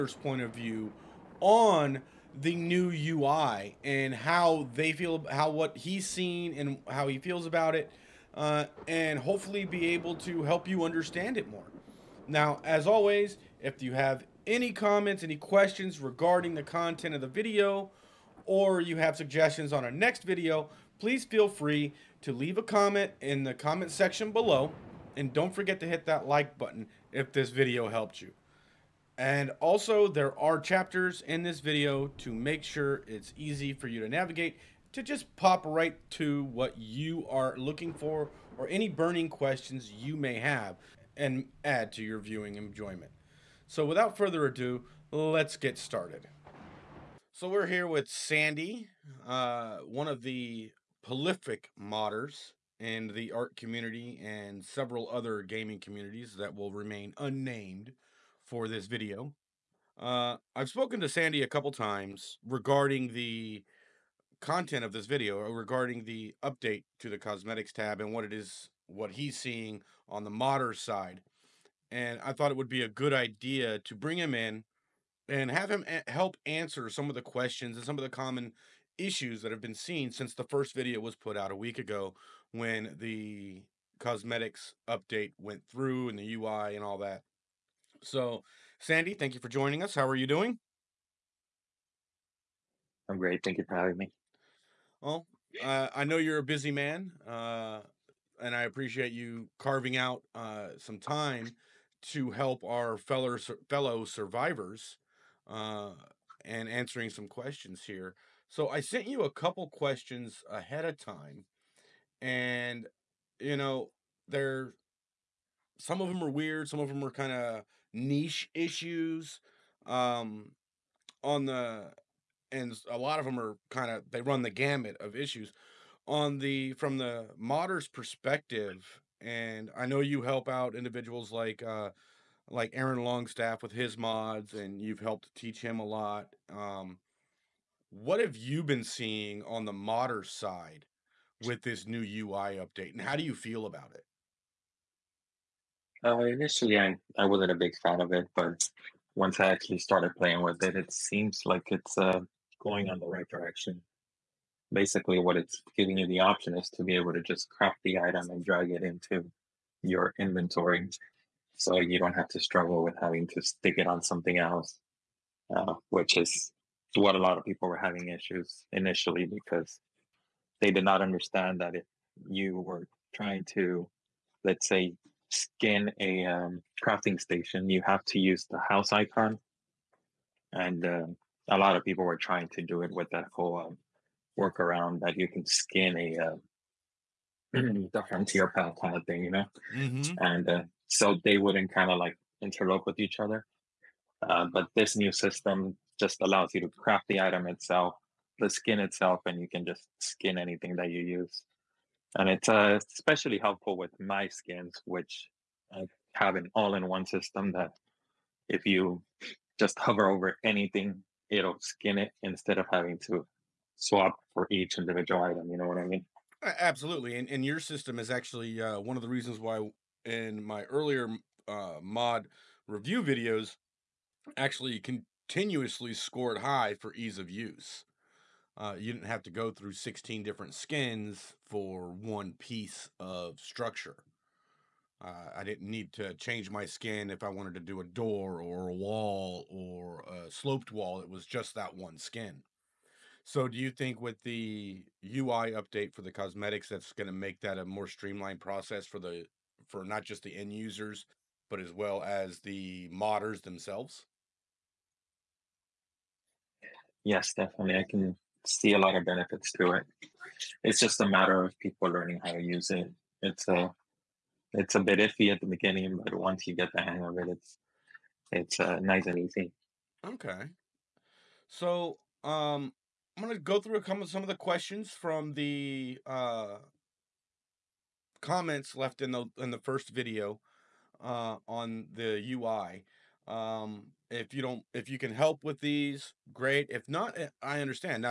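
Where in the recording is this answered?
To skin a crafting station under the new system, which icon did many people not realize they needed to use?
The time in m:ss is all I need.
2:58.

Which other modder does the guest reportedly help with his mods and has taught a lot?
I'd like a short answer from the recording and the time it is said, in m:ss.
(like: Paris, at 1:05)
Aaron Longstaff, at 2:12.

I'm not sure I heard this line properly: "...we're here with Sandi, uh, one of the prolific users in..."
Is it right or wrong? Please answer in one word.
wrong.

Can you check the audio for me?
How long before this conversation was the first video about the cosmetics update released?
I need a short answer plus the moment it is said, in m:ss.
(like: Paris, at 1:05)
a week ago, at 1:21.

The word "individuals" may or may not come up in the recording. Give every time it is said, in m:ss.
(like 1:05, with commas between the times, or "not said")
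2:10, 3:34.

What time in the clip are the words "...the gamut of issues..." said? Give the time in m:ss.
2:04.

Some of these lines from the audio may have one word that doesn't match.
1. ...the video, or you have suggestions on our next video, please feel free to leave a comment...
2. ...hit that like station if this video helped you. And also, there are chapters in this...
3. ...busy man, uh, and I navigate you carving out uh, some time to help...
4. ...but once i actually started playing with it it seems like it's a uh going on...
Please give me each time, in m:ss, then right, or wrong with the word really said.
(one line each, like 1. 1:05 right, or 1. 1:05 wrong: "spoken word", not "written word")
1. 0:17 right
2. 0:25 wrong: "button", not "station"
3. 1:36 wrong: "appreciate", not "navigate"
4. 2:28 right.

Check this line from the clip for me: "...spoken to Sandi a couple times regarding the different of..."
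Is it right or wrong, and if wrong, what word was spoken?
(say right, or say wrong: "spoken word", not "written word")
wrong: "content", not "different".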